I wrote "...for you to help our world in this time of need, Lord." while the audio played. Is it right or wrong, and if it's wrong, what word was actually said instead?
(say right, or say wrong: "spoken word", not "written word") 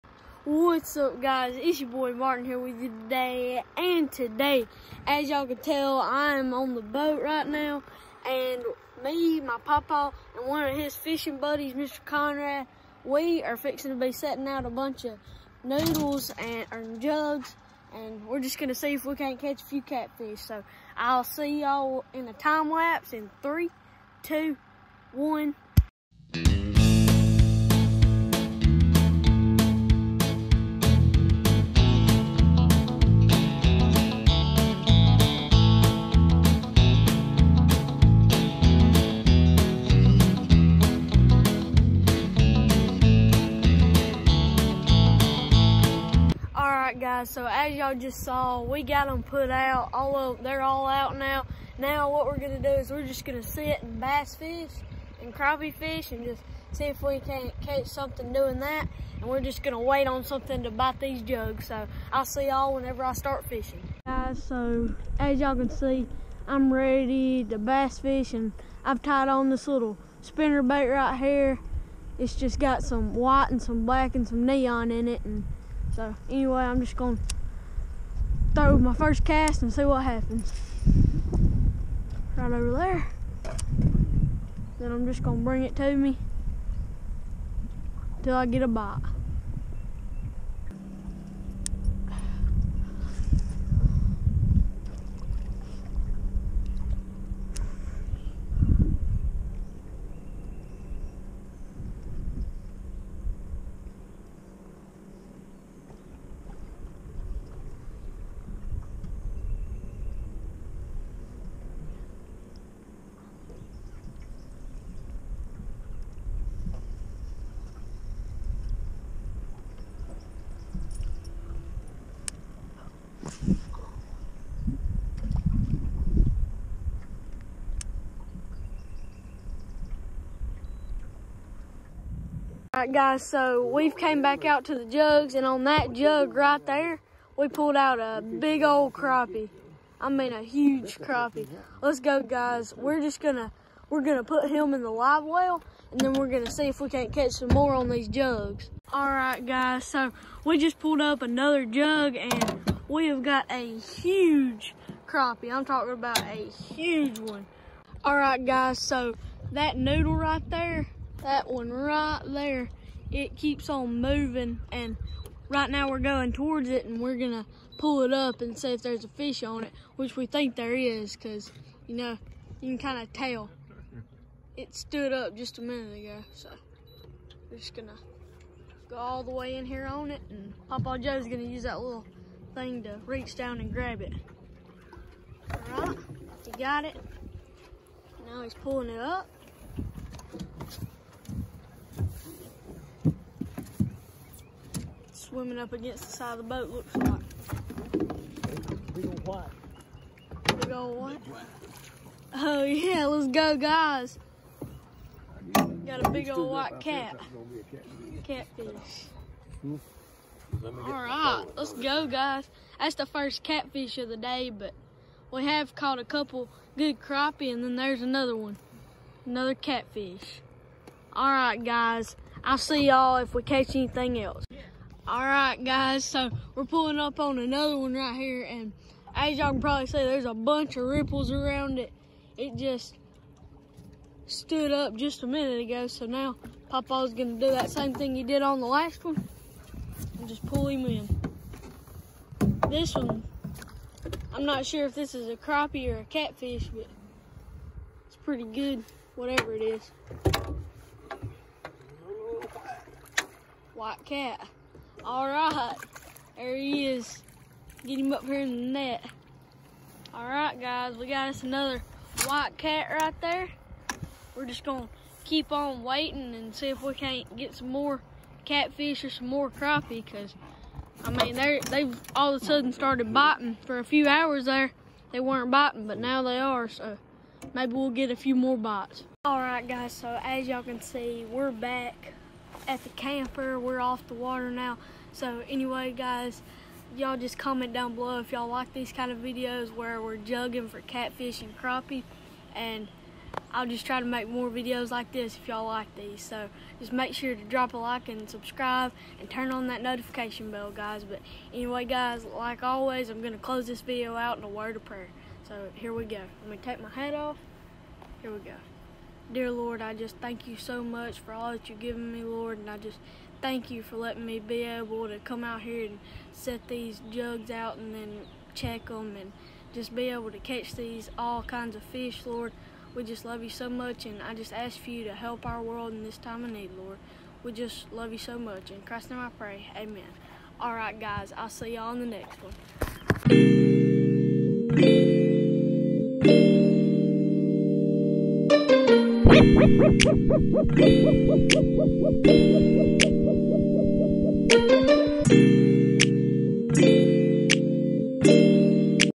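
right.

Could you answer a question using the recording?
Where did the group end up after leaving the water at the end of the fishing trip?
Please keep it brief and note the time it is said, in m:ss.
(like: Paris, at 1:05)
the camper, at 4:42.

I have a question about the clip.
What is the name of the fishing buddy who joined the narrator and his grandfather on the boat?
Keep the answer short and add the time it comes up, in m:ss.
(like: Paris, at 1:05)
Mr. Conrad, at 0:11.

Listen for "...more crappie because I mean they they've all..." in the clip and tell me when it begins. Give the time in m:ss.
4:29.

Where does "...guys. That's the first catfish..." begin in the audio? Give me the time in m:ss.
3:32.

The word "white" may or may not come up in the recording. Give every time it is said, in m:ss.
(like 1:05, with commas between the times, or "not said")
1:13, 3:26, 4:13, 4:22.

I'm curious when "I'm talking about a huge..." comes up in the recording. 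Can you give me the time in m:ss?
2:35.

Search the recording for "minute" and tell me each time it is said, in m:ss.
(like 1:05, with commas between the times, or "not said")
2:55, 3:55.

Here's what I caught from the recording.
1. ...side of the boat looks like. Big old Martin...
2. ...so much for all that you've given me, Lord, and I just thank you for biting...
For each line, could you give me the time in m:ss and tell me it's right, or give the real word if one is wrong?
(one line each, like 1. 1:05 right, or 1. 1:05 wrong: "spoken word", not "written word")
1. 3:16 wrong: "Big", not "Martin"
2. 5:10 wrong: "letting", not "biting".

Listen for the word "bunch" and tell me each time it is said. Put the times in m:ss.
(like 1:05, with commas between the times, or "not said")
0:14, 3:50.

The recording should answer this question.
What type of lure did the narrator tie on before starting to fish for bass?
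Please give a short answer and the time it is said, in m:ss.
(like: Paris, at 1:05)
spinner bait, at 1:10.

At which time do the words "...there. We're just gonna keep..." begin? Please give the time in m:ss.
4:23.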